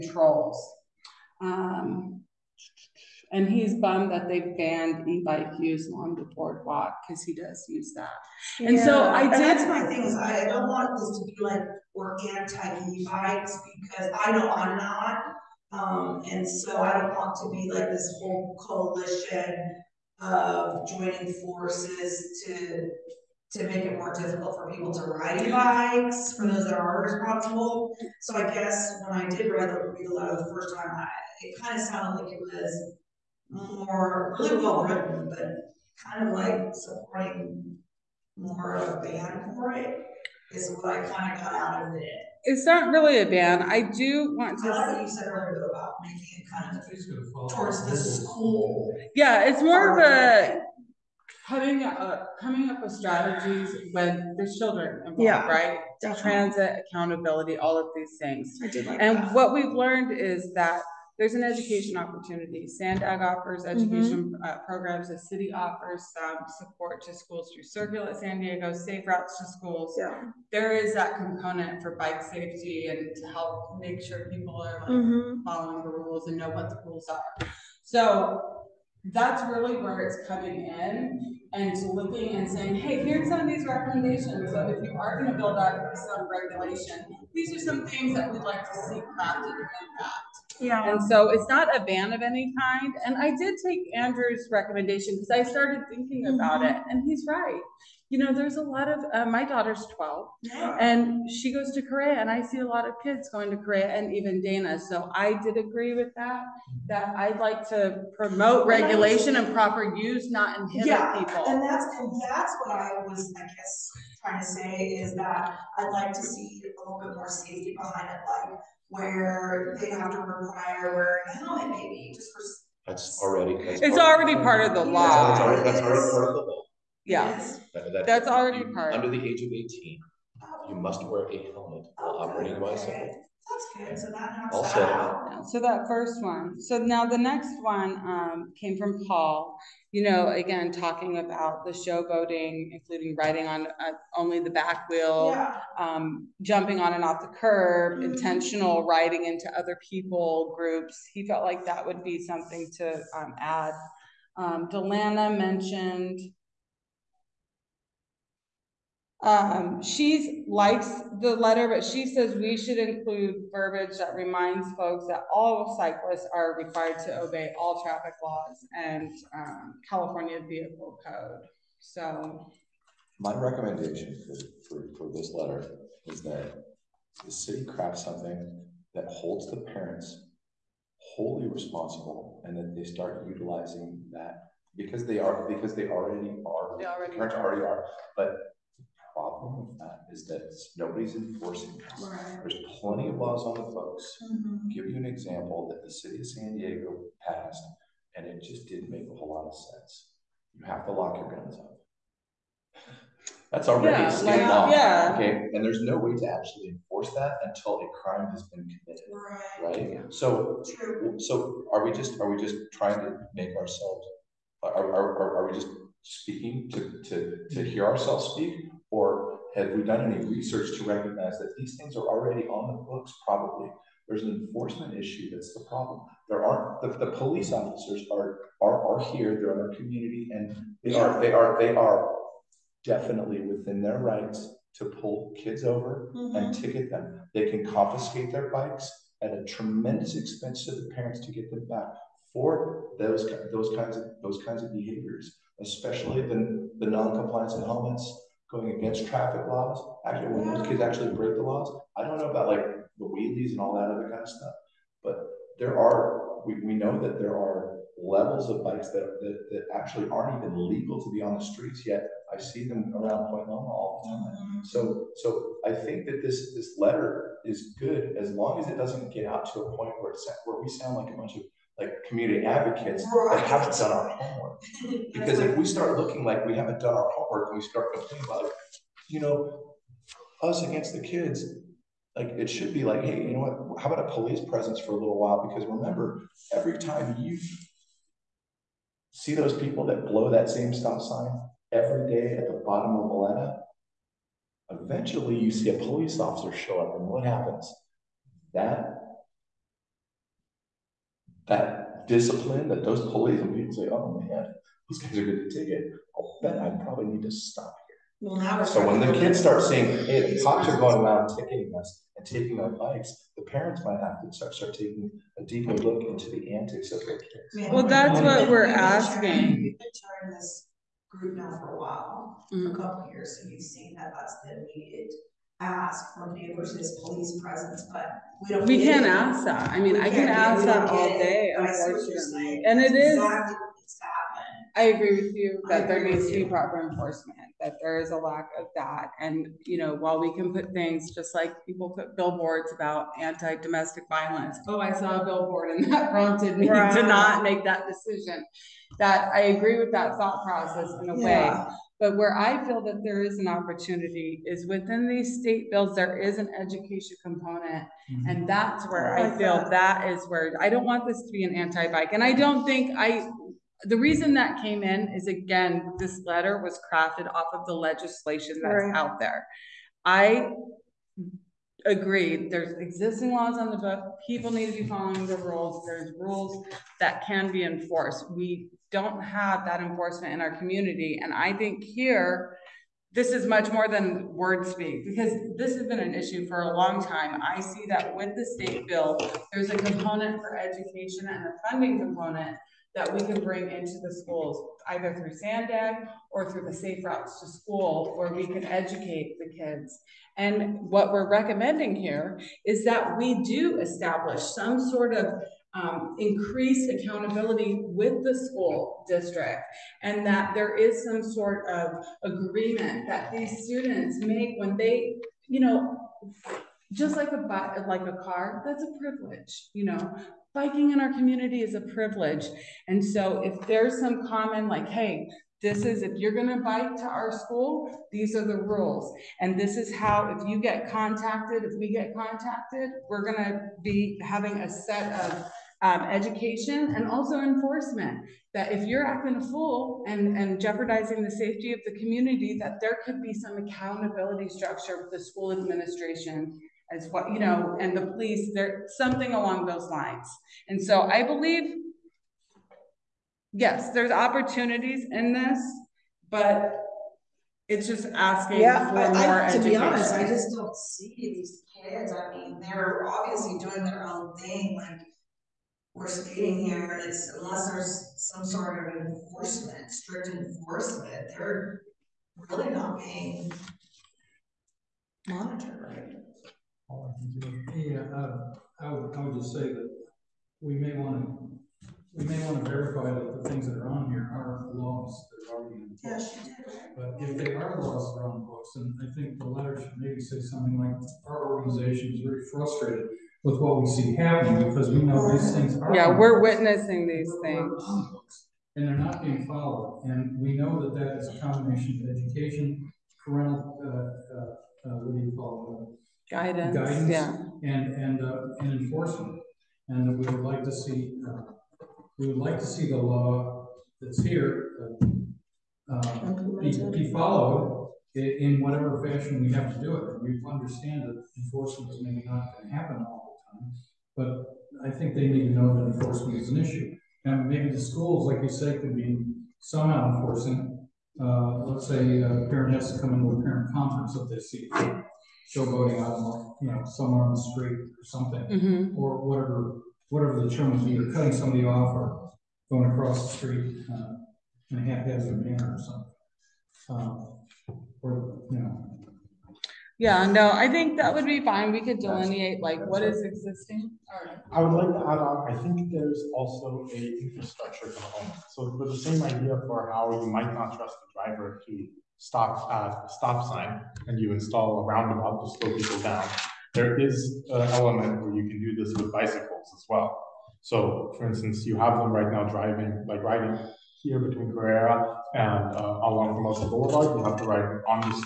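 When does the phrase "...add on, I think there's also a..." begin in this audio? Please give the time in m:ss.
9:15.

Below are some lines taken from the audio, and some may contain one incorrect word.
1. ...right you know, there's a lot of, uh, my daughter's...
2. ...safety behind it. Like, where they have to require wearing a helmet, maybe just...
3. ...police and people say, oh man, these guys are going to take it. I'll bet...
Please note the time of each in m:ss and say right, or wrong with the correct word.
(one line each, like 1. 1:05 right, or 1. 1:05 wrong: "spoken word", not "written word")
1. 1:37 right
2. 1:57 right
3. 5:03 right.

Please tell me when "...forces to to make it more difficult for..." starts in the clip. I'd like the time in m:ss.
0:21.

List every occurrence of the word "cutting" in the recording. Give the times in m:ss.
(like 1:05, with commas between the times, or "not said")
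9:01.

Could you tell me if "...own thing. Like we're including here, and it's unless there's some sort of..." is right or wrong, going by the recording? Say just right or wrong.
wrong.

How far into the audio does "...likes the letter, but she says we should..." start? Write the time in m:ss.
2:40.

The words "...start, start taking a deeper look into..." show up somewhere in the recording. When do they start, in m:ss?
5:14.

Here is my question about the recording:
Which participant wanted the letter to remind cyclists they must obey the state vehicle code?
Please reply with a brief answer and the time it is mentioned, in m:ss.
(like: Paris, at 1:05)
Delana, at 2:34.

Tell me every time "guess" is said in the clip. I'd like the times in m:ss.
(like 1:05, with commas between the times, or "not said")
0:28, 1:53.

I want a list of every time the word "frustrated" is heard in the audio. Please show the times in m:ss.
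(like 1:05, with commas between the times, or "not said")
8:12.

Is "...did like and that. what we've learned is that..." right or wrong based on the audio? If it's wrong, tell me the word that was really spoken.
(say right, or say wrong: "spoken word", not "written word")
right.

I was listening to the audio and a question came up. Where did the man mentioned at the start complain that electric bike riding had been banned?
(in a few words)
The boardwalk.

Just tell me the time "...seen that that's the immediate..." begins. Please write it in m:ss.
5:23.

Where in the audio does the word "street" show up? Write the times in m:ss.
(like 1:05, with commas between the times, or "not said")
4:21, 8:57, 9:03.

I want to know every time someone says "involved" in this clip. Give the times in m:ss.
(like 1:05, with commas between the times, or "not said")
0:54.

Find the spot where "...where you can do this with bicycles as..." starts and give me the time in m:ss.
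9:28.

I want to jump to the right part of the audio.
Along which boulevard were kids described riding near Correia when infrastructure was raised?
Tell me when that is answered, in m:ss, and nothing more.
9:36.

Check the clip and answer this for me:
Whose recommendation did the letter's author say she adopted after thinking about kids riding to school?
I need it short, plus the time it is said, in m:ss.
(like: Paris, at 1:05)
Andrew, at 1:33.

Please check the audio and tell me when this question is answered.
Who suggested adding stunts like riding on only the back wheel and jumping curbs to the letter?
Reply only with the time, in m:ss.
2:19.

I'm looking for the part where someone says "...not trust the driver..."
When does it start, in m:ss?
9:20.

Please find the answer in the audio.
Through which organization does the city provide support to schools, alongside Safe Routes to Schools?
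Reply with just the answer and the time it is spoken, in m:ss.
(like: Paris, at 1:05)
Circulate San Diego, at 1:07.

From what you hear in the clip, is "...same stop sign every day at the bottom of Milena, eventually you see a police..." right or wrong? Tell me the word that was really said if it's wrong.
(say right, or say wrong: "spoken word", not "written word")
right.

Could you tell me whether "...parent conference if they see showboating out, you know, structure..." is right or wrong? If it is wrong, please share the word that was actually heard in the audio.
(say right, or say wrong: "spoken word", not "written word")
wrong: "somewhere", not "structure".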